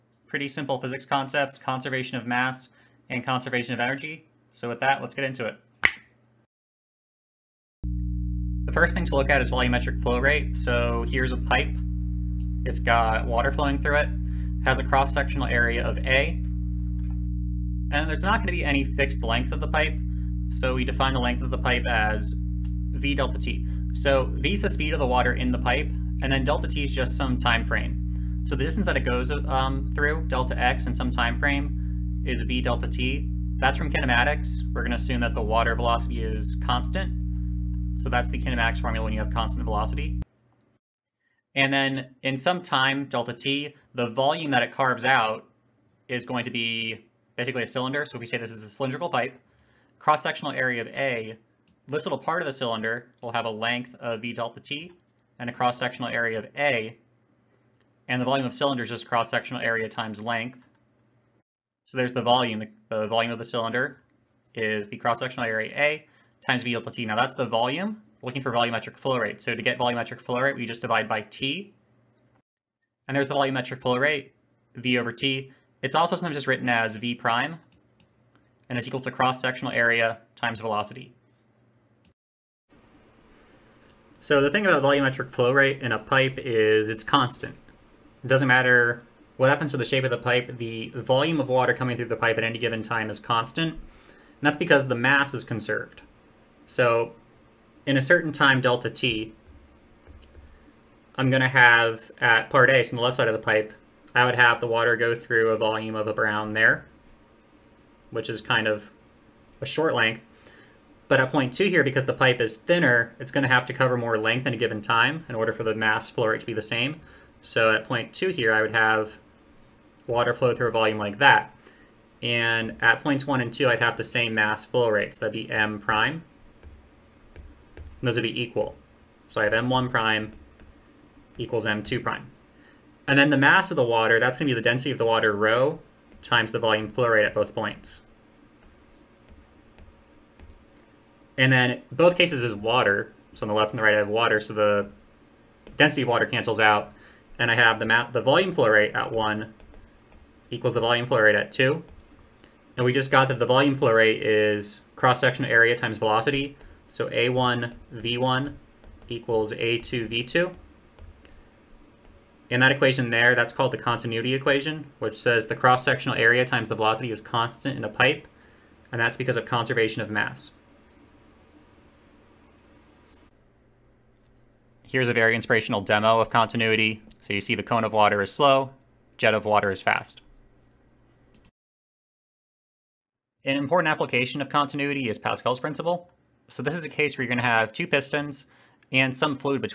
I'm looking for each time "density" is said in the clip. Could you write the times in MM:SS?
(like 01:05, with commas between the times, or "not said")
02:14, 02:25.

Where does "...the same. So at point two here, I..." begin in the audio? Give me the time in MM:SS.
01:56.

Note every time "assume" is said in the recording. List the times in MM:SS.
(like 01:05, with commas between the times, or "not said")
00:34.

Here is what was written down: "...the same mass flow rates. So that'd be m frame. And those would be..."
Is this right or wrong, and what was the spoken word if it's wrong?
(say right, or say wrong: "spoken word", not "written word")
wrong: "prime", not "frame".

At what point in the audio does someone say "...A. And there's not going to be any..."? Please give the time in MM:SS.
00:15.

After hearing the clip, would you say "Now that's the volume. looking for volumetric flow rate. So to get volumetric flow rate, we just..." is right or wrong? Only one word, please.
right.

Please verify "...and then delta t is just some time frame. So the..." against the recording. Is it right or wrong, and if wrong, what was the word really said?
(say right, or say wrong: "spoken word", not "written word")
right.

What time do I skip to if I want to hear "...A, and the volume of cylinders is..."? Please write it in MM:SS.
00:56.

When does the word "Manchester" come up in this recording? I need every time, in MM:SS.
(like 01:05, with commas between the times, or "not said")
not said.